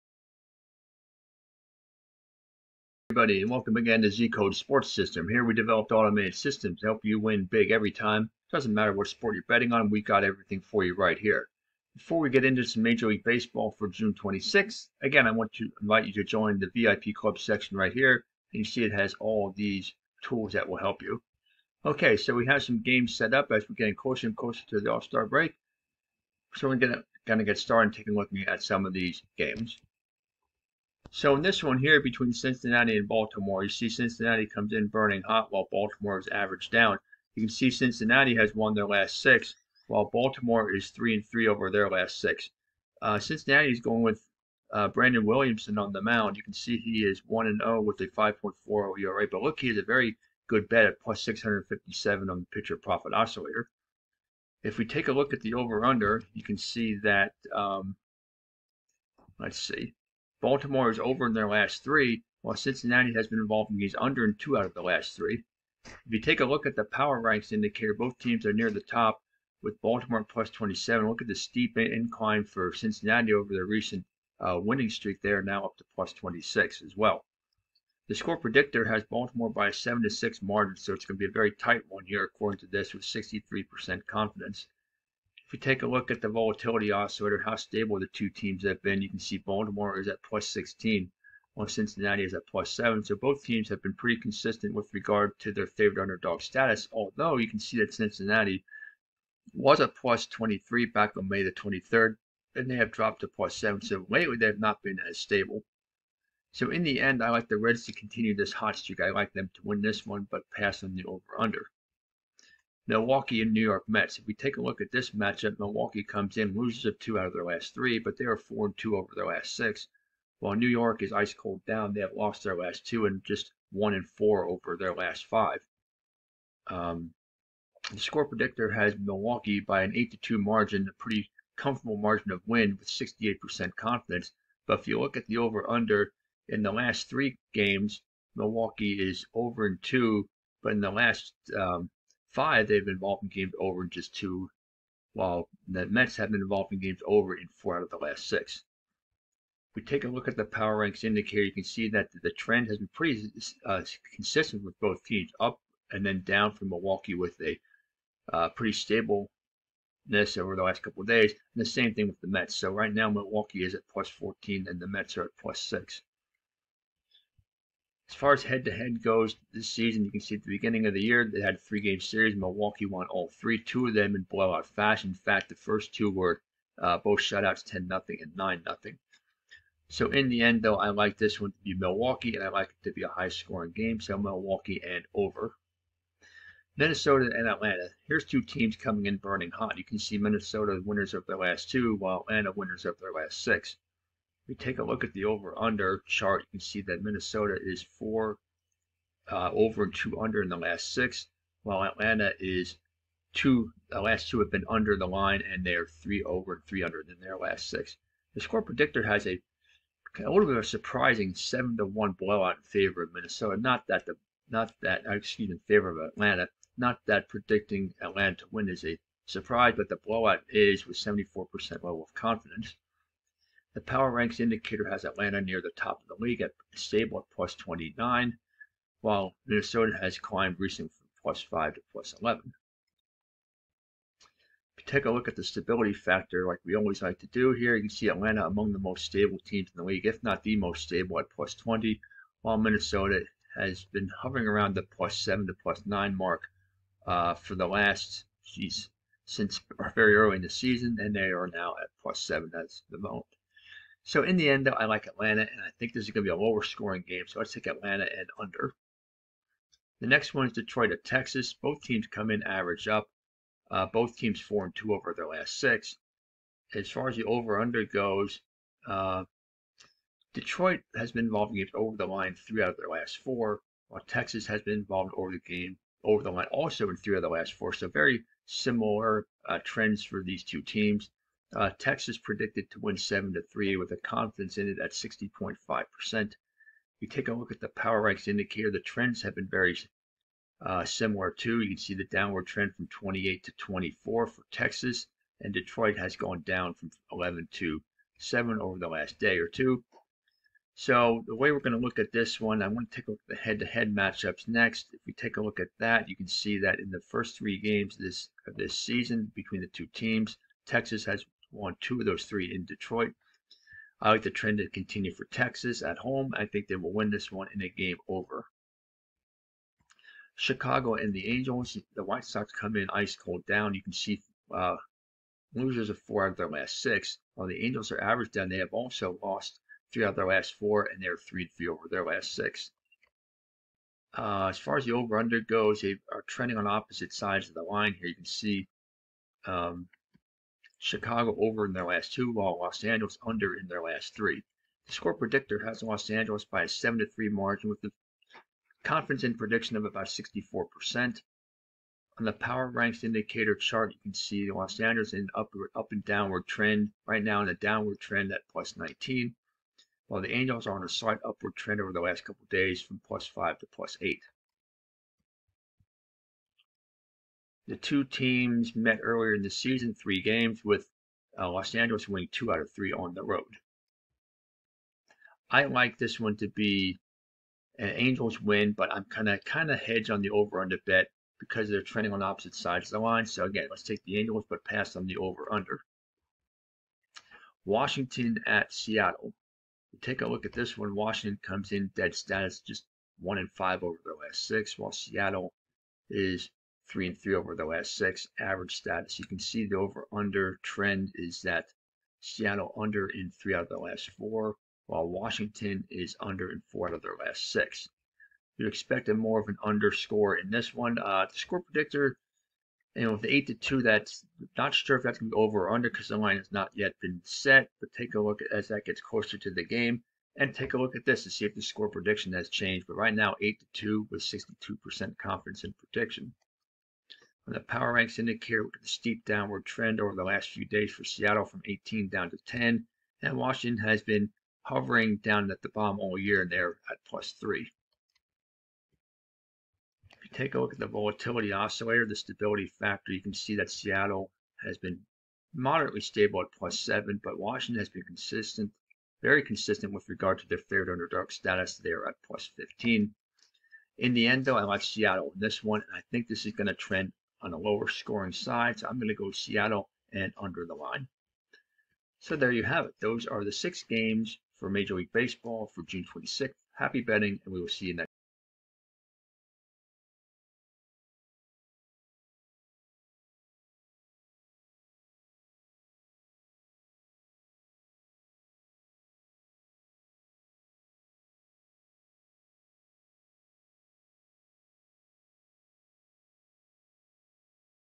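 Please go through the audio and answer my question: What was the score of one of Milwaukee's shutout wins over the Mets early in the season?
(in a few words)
10-0.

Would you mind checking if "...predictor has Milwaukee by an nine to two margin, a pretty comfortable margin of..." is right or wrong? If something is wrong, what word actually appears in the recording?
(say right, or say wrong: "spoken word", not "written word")
wrong: "eight", not "nine".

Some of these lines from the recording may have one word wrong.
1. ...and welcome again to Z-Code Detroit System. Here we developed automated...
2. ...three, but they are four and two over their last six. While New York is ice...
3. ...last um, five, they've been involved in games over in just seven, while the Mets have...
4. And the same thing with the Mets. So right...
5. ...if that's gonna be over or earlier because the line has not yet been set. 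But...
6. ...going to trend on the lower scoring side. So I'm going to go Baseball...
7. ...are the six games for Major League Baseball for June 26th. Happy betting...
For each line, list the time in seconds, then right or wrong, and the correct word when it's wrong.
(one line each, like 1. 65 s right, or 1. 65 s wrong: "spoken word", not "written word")
1. 3 s wrong: "Sports", not "Detroit"
2. 117 s right
3. 140 s wrong: "two", not "seven"
4. 161 s right
5. 414 s wrong: "under", not "earlier"
6. 456 s wrong: "Seattle", not "Baseball"
7. 463 s right.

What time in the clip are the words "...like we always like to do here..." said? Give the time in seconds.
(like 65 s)
236 s.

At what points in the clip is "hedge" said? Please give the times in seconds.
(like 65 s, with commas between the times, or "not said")
379 s.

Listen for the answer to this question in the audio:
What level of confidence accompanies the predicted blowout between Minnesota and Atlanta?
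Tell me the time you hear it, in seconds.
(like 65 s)
220 s.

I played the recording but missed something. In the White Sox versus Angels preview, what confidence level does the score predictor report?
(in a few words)
64%.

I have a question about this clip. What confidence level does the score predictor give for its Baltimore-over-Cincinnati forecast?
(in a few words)
63%.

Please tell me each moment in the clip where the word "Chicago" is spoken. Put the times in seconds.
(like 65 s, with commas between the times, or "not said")
320 s, 340 s.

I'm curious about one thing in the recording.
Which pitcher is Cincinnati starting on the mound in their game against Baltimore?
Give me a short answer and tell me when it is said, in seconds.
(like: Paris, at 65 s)
Brandon Williamson, at 44 s.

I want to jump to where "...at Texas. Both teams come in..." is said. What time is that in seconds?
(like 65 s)
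260 s.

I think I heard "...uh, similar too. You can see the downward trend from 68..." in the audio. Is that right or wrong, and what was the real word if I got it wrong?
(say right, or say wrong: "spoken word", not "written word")
wrong: "28", not "68".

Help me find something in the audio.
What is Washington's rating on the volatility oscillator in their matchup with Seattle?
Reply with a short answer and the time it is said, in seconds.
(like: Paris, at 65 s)
+15, at 452 s.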